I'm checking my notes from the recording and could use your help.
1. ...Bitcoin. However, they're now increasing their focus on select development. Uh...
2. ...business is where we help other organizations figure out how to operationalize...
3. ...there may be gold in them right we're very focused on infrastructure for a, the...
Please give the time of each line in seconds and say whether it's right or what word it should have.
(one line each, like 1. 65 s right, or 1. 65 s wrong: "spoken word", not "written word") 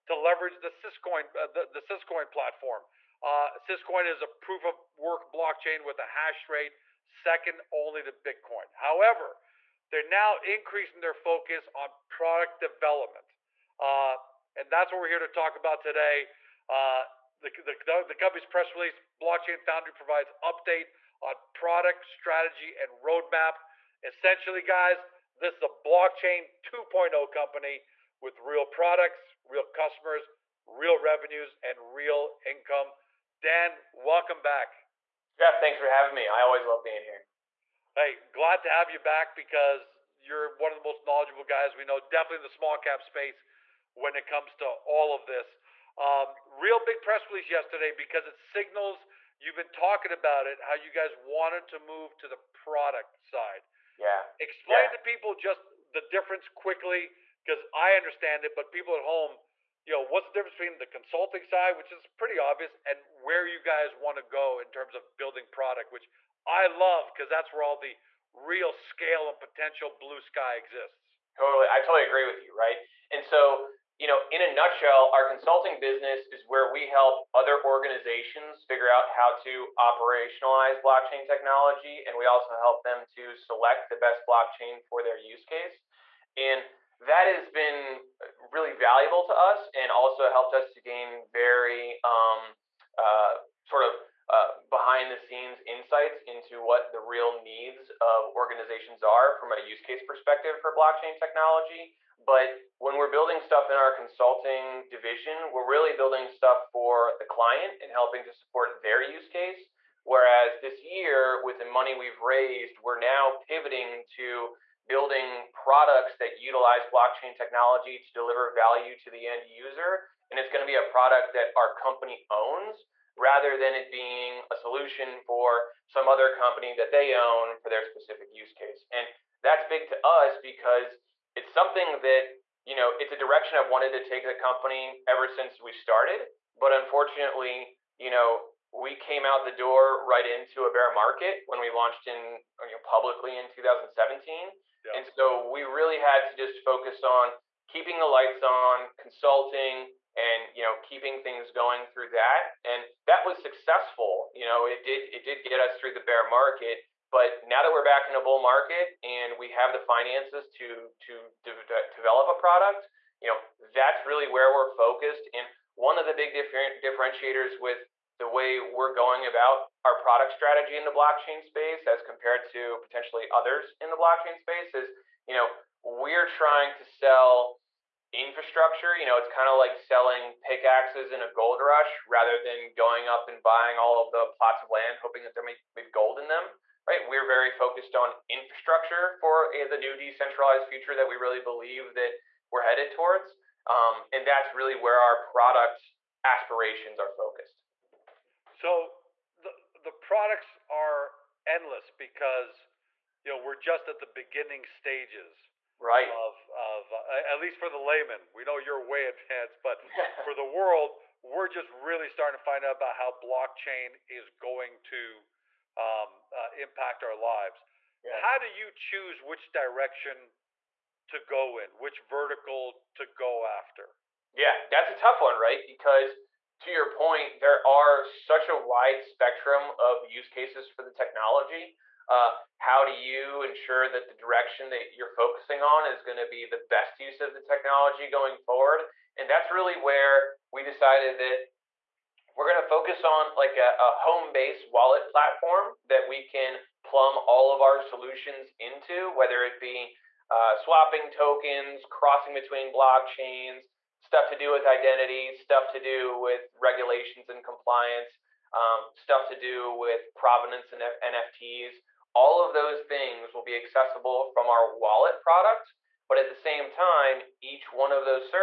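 1. 8 s wrong: "product", not "select"
2. 75 s right
3. 185 s right.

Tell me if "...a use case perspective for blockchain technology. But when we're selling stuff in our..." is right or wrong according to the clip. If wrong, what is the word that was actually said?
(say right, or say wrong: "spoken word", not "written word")
wrong: "building", not "selling".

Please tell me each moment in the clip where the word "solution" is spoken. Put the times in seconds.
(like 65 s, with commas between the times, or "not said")
124 s, 247 s.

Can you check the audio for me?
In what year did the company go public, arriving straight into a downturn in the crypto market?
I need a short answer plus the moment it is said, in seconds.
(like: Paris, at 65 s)
2017, at 143 s.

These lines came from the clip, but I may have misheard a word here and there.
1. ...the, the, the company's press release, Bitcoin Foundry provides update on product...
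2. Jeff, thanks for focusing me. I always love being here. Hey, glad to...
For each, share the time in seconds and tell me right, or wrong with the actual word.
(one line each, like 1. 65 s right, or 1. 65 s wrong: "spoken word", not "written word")
1. 17 s wrong: "Blockchain", not "Bitcoin"
2. 35 s wrong: "having", not "focusing".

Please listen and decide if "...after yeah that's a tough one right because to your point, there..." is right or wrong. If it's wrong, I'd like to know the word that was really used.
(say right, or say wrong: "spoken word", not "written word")
right.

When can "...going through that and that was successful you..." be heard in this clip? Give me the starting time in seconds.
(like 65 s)
151 s.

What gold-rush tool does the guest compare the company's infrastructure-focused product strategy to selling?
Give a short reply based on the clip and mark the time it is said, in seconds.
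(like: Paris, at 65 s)
Pickaxes, at 180 s.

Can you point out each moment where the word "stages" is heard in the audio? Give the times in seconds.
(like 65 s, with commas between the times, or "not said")
204 s.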